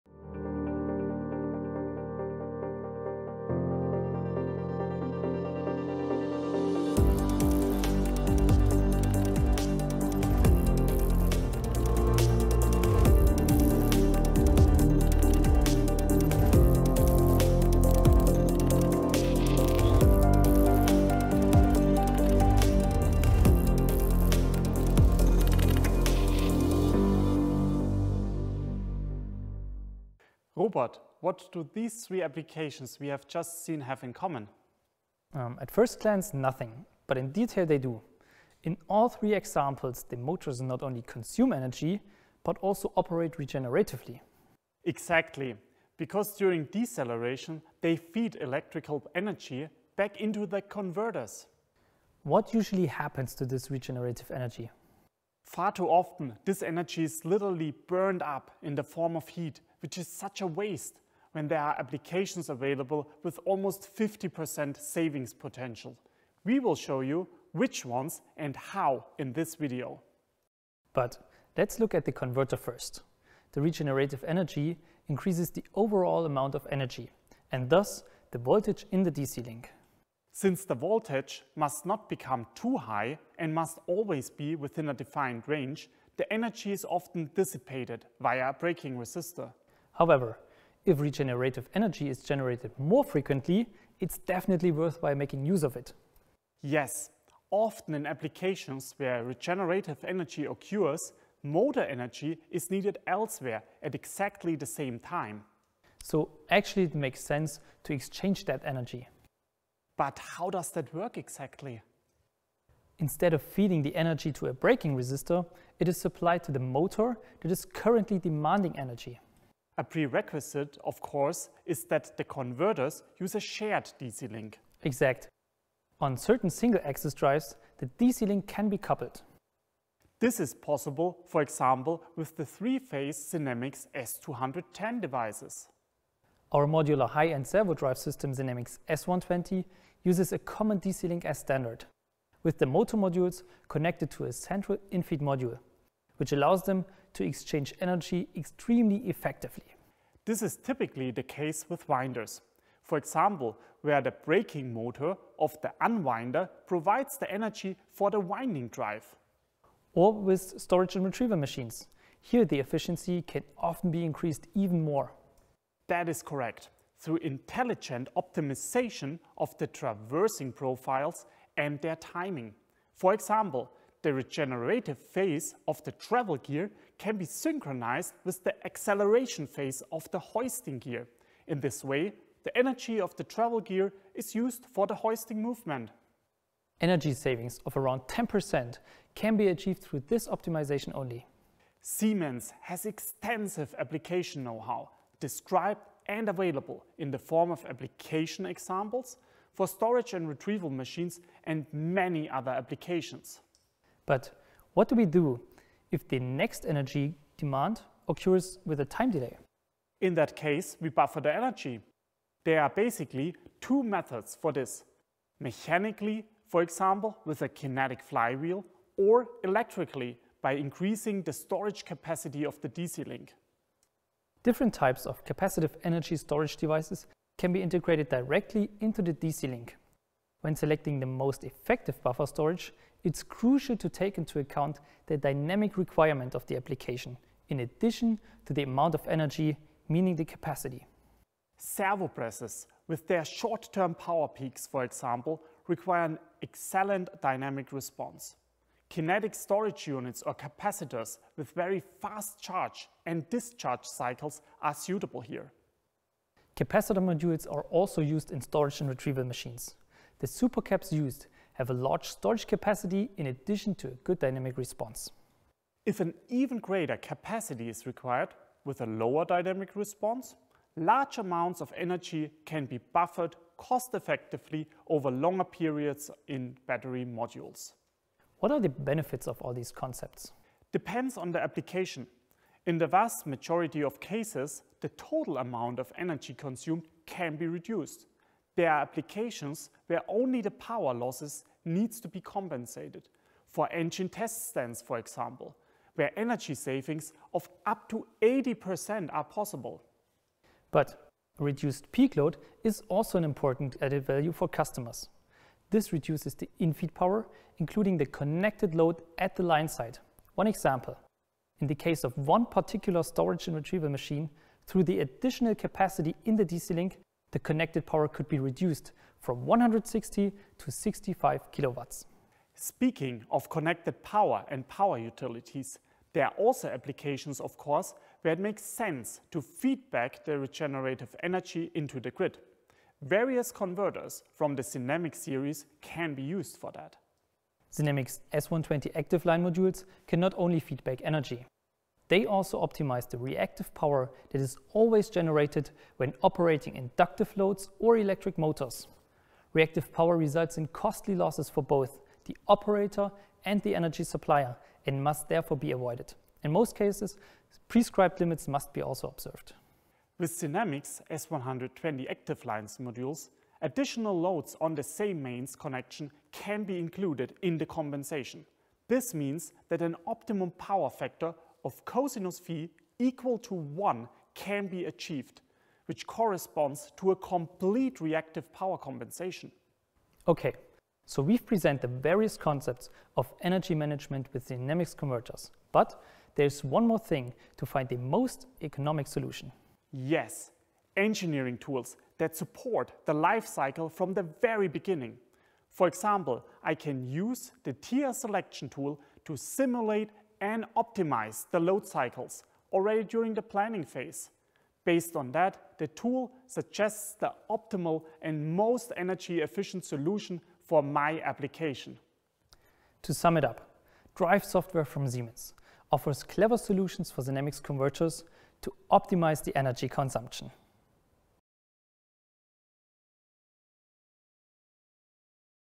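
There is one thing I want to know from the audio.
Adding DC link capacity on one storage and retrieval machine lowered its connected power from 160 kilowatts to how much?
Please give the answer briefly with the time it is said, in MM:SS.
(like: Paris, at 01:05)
65 kW, at 05:20.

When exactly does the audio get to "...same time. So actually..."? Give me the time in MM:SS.
01:44.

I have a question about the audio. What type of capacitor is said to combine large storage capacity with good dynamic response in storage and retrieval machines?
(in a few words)
supercaps.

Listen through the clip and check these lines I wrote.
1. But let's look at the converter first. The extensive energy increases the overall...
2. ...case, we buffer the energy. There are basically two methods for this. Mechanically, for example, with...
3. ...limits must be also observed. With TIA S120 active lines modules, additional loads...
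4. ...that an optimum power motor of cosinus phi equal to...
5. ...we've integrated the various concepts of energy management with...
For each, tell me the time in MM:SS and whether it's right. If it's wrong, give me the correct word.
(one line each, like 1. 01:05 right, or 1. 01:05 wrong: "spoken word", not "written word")
1. 01:10 wrong: "regenerative", not "extensive"
2. 03:30 right
3. 05:58 wrong: "Sinamics", not "TIA"
4. 06:09 wrong: "factor", not "motor"
5. 06:21 wrong: "presented", not "integrated".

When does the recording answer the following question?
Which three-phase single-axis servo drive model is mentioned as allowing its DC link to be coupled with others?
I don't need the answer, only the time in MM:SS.
02:13.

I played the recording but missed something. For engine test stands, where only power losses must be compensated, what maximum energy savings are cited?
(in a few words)
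80%.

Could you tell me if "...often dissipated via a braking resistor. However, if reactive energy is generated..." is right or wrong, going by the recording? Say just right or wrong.
wrong.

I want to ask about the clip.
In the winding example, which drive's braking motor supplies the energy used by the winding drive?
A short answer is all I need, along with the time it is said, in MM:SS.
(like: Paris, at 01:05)
the unwinder, at 02:35.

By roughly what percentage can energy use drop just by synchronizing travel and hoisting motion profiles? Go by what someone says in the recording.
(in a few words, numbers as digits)
10%.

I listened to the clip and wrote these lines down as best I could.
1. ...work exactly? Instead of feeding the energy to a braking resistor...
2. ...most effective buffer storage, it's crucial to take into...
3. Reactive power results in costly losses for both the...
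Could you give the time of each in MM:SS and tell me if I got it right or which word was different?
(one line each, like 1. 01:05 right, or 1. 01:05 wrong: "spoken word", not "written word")
1. 01:50 right
2. 03:51 right
3. 05:49 right.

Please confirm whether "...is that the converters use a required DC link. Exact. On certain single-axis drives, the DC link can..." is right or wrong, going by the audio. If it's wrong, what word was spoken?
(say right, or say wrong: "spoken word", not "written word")
wrong: "shared", not "required".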